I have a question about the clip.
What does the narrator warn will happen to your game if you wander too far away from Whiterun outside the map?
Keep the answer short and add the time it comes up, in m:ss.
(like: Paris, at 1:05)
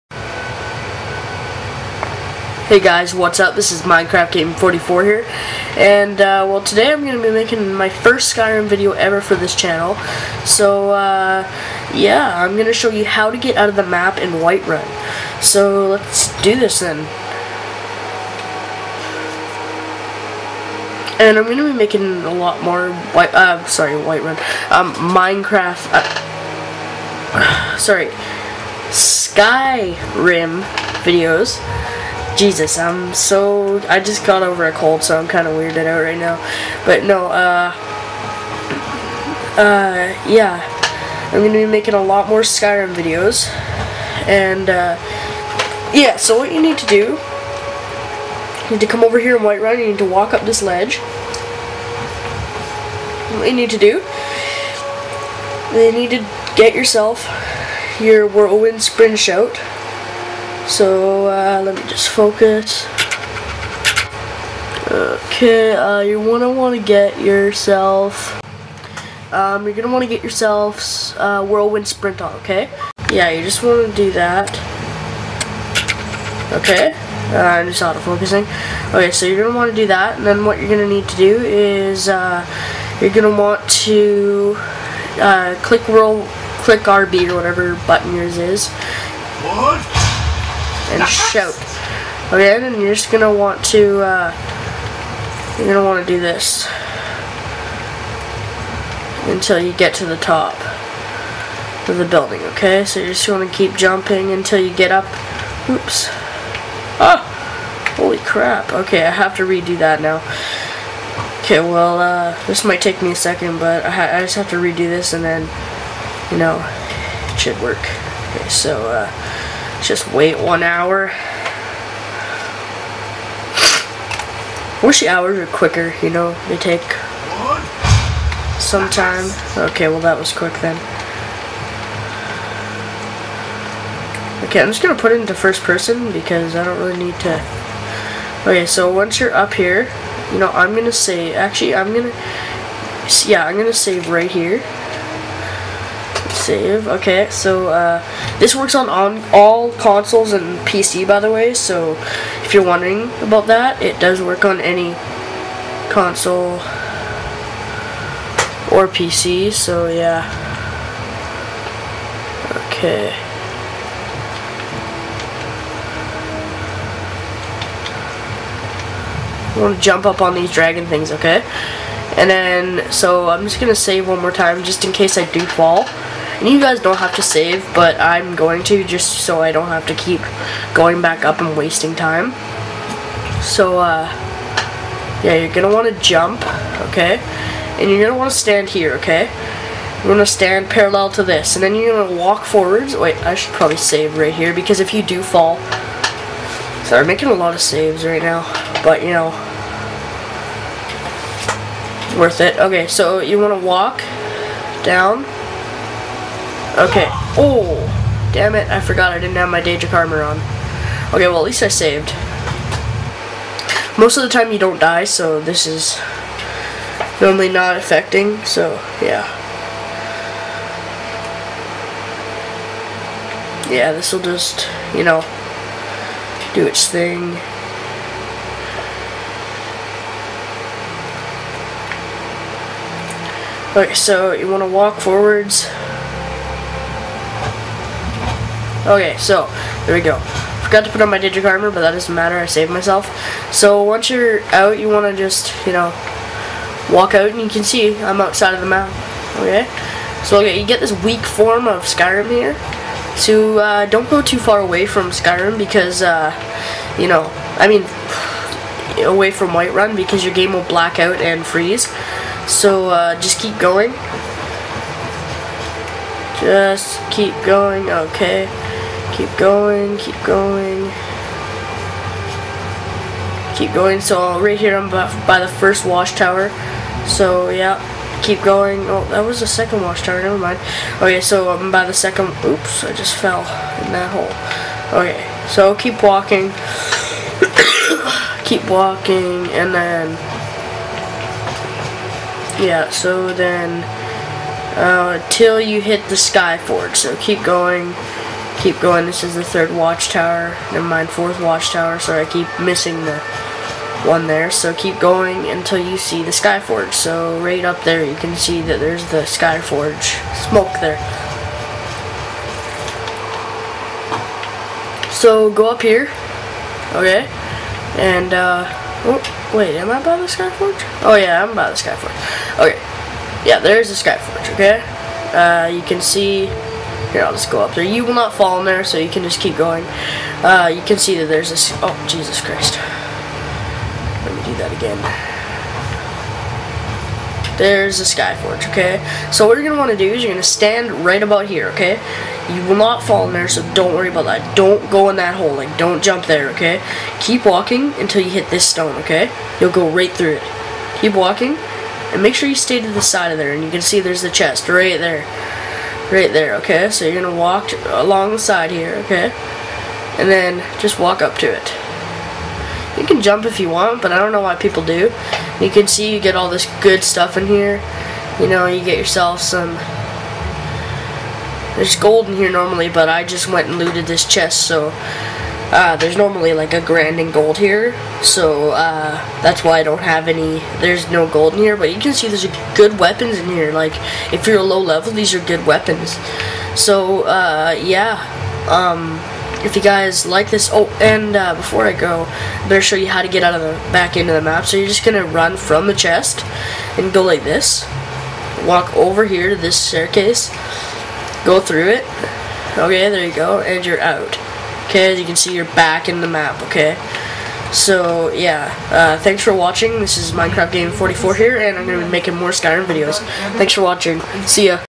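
black out and freeze, at 4:20.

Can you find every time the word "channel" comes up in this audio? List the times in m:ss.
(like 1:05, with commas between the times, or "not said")
0:09.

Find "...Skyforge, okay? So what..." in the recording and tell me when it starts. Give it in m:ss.
5:38.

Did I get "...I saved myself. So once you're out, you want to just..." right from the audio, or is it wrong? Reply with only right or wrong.
right.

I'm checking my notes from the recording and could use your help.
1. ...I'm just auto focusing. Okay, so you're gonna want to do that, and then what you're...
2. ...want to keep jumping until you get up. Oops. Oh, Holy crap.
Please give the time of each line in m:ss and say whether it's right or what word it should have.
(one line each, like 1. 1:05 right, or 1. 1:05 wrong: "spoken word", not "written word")
1. 1:17 right
2. 1:43 right.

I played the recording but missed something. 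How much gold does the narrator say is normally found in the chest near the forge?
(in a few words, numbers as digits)
a grand.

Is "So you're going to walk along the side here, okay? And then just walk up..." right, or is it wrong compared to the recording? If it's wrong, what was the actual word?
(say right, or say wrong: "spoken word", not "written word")
right.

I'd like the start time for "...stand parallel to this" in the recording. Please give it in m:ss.
3:10.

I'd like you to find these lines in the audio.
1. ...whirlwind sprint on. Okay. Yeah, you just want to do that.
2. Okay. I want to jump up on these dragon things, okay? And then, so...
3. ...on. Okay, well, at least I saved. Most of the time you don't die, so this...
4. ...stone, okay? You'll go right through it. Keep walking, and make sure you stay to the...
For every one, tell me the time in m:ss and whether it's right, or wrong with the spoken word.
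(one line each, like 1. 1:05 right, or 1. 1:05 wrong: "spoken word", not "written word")
1. 1:11 right
2. 2:42 right
3. 3:30 right
4. 5:48 right.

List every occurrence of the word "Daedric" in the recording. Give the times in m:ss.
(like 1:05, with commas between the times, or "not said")
3:29, 4:01.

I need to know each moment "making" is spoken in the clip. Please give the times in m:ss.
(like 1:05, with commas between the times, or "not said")
0:07, 0:21, 0:41, 3:17, 6:52.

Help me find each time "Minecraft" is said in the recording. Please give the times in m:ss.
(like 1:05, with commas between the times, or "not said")
0:03, 0:24, 6:50.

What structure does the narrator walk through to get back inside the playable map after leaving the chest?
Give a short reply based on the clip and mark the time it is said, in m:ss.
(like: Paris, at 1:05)
staircase, at 6:39.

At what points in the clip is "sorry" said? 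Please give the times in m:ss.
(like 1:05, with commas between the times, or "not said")
0:23, 0:27, 5:01.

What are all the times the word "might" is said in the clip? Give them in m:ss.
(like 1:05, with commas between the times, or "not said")
1:52.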